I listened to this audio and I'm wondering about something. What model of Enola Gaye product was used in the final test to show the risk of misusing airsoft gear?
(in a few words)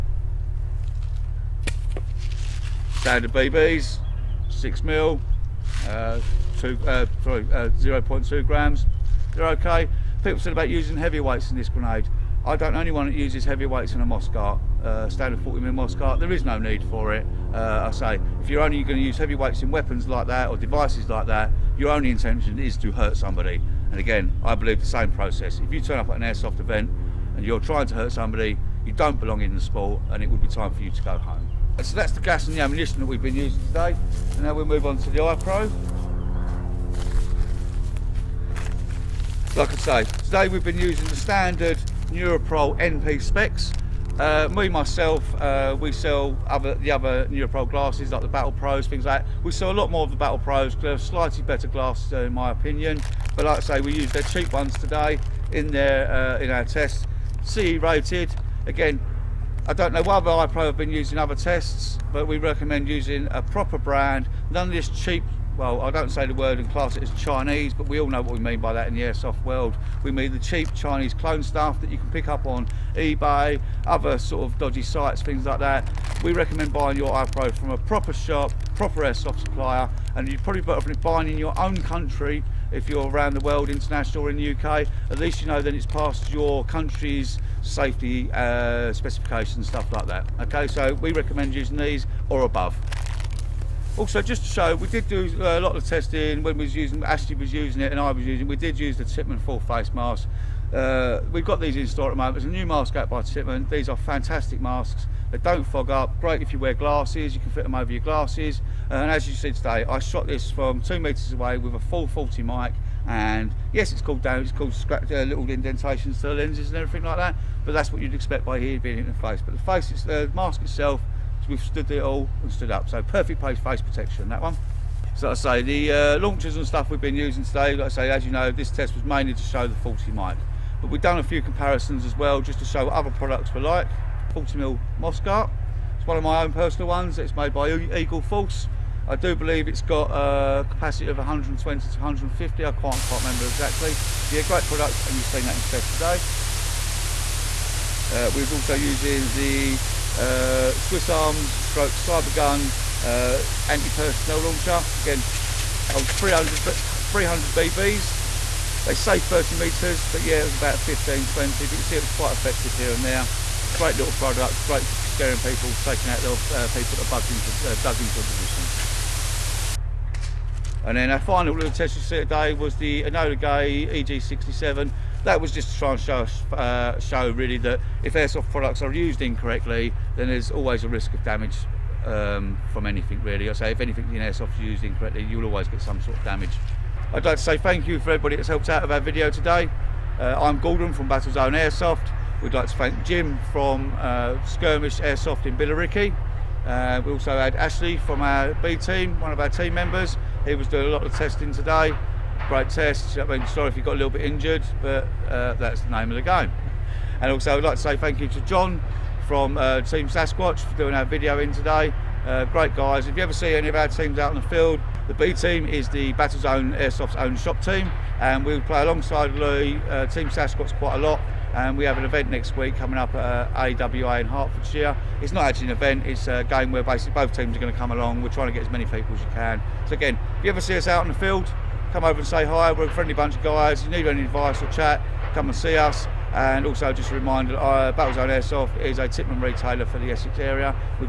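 EG67.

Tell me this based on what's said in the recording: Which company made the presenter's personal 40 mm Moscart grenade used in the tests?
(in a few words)
Eagle Force.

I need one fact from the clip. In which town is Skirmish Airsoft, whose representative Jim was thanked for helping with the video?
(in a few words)
Billericay.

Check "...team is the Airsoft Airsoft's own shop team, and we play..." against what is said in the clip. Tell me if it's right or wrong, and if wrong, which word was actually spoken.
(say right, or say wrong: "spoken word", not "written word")
wrong: "Battlezone", not "Airsoft".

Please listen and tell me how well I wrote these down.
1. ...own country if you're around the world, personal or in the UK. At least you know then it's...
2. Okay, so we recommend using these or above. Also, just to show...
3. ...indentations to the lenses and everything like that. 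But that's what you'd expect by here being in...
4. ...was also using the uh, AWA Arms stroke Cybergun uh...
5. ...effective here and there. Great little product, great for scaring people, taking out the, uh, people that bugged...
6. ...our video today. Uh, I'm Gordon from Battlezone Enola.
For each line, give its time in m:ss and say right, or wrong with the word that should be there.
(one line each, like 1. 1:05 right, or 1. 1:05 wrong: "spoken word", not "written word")
1. 1:21 wrong: "international", not "personal"
2. 1:30 right
3. 1:55 right
4. 2:28 wrong: "Swiss", not "AWA"
5. 2:42 right
6. 3:08 wrong: "Airsoft", not "Enola".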